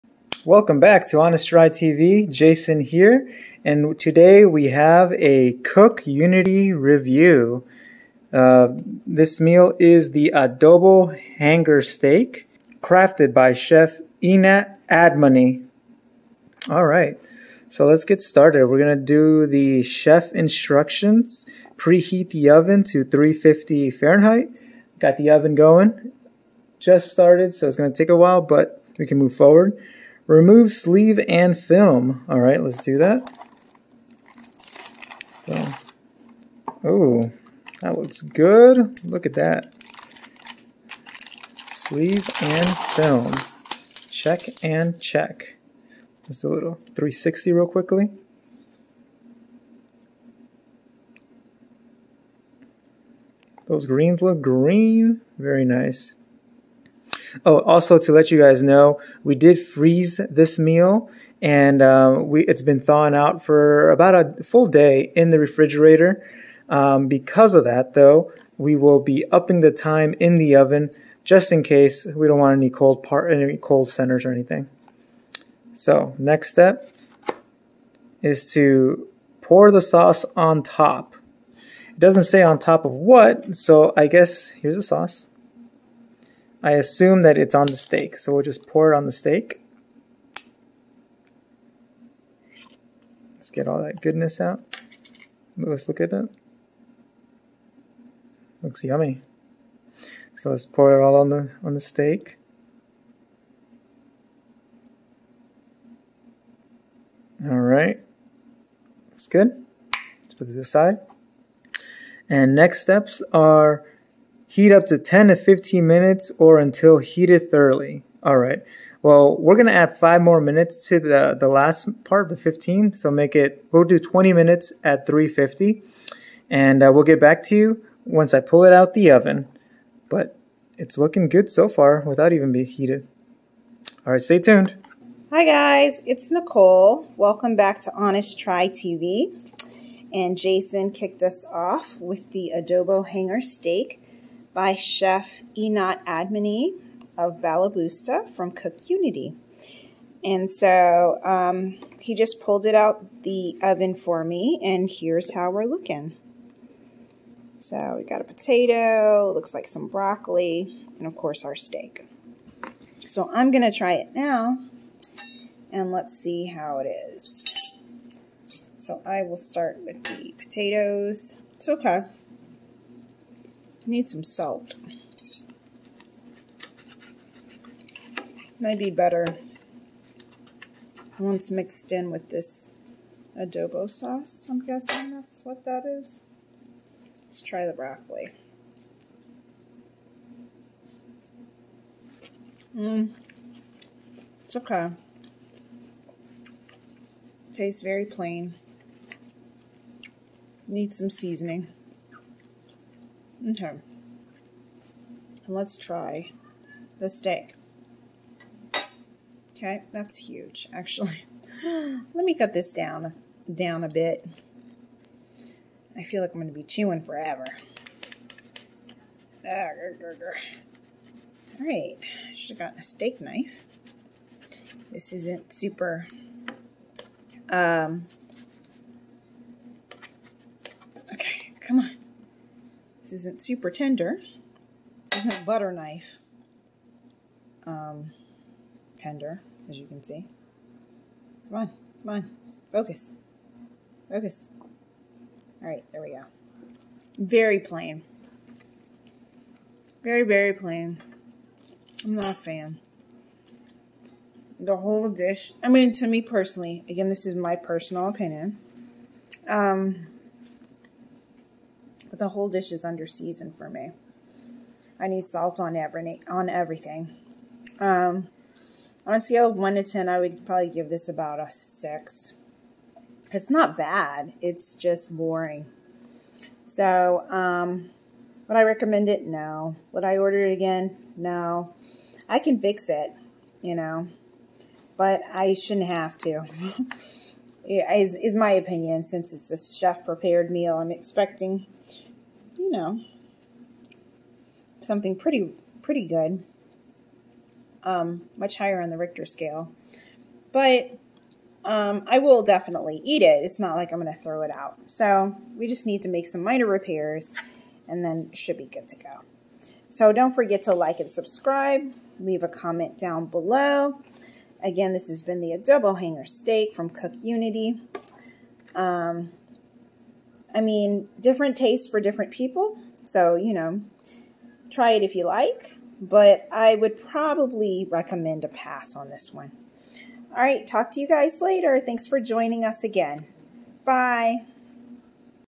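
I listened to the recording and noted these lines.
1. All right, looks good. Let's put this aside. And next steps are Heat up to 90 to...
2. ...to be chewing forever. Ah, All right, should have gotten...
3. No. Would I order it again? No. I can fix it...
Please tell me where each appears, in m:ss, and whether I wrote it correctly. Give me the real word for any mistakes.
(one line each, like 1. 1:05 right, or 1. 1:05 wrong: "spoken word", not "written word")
1. 1:47 wrong: "10", not "90"
2. 3:36 right
3. 4:39 right.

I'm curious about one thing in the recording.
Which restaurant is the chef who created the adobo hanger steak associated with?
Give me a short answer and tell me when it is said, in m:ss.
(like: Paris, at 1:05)
Balaboosta, at 2:27.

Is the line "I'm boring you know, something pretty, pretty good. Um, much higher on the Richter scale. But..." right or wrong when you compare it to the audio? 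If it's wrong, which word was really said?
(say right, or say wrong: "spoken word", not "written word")
wrong: "expecting", not "boring".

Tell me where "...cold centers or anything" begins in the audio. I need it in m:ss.
1:13.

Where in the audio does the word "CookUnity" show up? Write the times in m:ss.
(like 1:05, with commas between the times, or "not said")
0:05, 2:28, 5:16.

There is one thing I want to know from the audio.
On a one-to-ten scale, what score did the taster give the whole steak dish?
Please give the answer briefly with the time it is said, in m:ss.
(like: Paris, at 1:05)
6, at 4:31.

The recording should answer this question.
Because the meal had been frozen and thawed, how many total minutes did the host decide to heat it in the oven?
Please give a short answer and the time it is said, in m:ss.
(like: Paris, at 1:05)
20 minutes, at 2:03.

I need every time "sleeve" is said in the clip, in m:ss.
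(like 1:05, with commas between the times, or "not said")
0:30, 0:41.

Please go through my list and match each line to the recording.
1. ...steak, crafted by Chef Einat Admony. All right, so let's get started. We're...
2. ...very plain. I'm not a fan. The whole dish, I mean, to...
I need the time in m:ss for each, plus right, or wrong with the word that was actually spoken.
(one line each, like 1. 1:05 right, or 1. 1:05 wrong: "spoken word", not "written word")
1. 0:11 right
2. 4:10 right.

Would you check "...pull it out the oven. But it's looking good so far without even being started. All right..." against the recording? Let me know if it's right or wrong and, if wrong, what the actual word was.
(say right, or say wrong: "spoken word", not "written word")
wrong: "heated", not "started".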